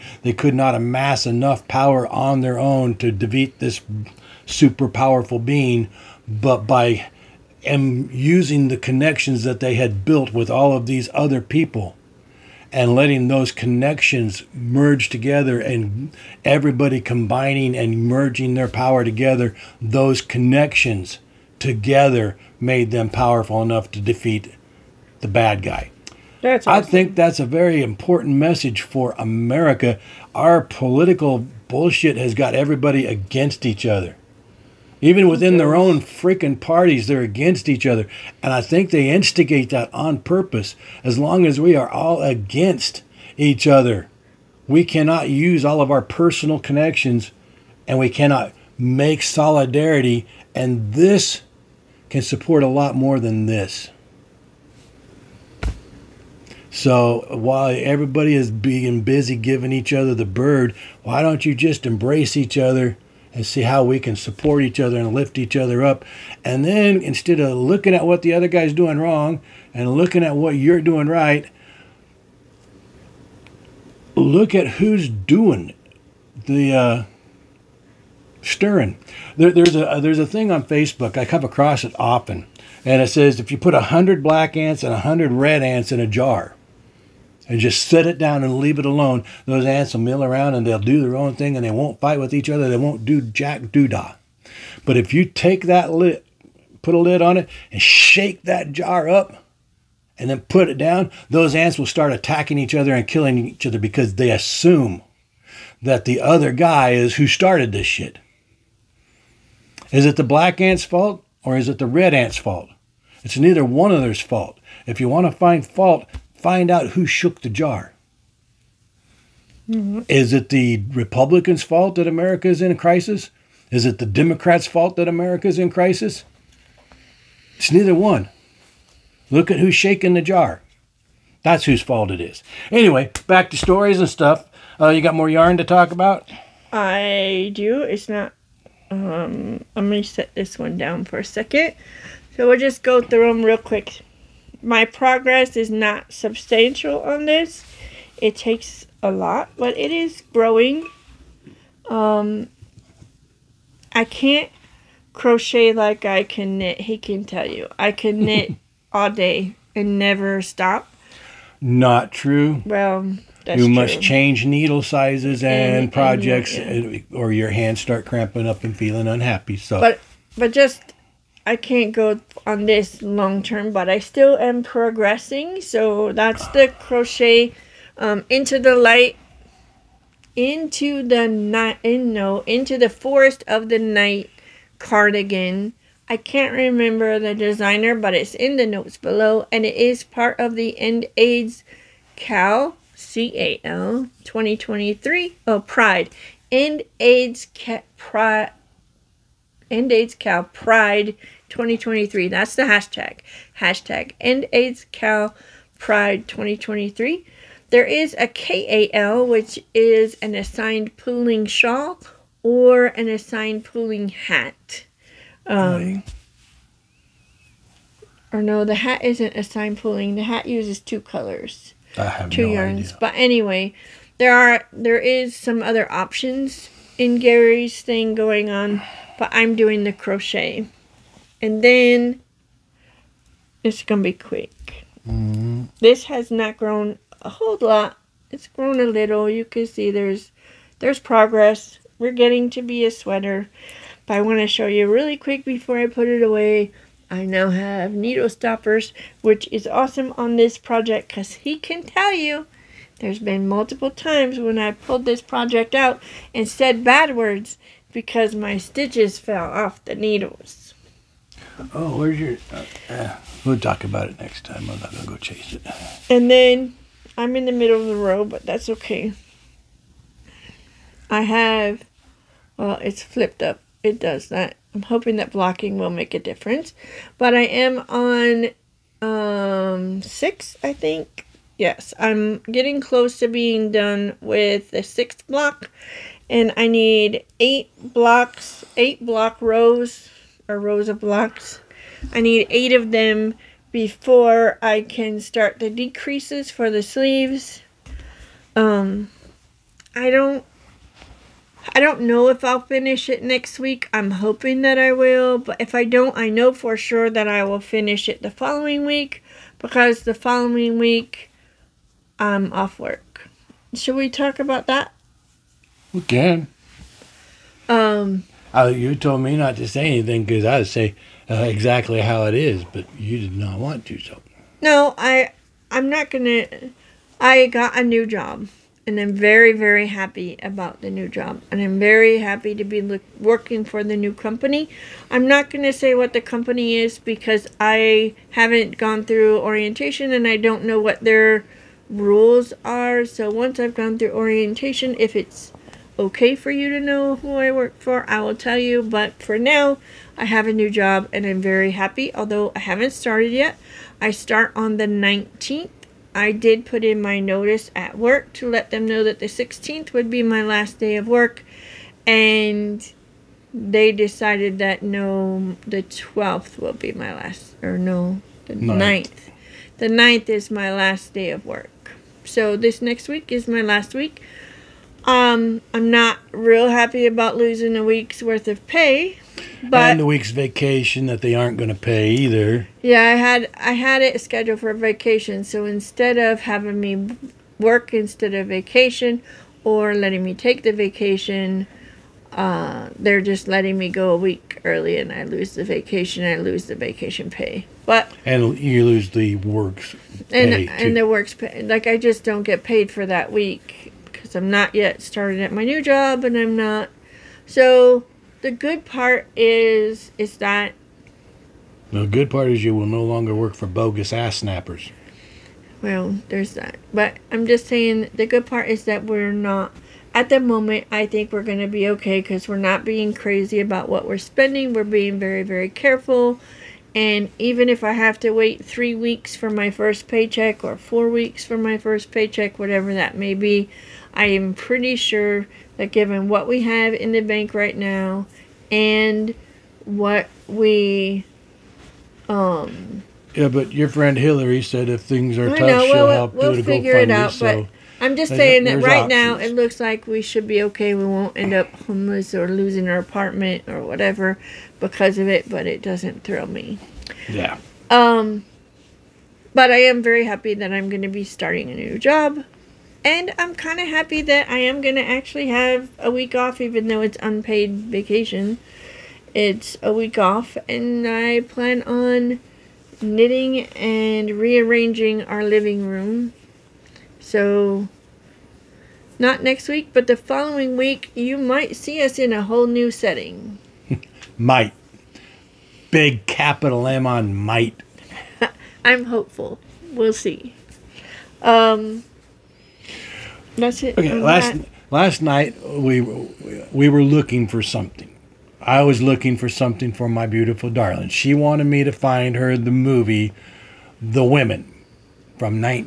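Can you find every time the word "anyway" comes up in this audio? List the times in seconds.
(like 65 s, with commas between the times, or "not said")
132 s, 223 s.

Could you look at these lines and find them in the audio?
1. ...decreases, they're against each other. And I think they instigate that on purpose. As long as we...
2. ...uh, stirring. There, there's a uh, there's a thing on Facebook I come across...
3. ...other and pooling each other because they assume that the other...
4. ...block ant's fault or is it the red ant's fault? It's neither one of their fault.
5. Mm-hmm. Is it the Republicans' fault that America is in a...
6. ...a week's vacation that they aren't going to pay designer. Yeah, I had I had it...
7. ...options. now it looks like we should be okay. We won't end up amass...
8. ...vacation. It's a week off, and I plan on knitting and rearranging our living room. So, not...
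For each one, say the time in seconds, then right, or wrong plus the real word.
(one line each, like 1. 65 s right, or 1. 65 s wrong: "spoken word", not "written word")
1. 36 s wrong: "parties", not "decreases"
2. 76 s right
3. 102 s wrong: "killing", not "pooling"
4. 110 s wrong: "black", not "block"
5. 119 s right
6. 379 s wrong: "either", not "designer"
7. 449 s wrong: "homeless", not "amass"
8. 467 s right.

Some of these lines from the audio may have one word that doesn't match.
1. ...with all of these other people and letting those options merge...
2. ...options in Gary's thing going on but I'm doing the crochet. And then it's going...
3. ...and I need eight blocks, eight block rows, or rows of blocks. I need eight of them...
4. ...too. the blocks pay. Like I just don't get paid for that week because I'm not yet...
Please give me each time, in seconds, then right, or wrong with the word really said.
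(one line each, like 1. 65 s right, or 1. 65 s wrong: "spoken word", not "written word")
1. 10 s wrong: "connections", not "options"
2. 225 s right
3. 286 s right
4. 400 s wrong: "works", not "blocks".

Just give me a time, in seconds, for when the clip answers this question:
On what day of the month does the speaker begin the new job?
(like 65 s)
354 s.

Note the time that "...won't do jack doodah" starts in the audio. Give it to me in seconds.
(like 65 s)
92 s.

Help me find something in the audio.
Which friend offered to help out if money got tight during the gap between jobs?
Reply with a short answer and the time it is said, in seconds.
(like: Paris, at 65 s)
Hillary, at 444 s.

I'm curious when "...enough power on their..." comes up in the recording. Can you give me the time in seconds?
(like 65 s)
1 s.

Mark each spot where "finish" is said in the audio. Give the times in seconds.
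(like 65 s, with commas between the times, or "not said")
302 s, 307 s.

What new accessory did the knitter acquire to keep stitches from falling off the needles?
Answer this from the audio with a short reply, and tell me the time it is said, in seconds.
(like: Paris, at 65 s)
needle stoppers, at 247 s.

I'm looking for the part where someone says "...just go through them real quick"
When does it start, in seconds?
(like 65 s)
142 s.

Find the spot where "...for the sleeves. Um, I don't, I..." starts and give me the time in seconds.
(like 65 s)
296 s.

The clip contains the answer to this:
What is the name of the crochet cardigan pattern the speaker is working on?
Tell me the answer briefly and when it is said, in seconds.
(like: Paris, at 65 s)
Into the Forest of the Night, at 182 s.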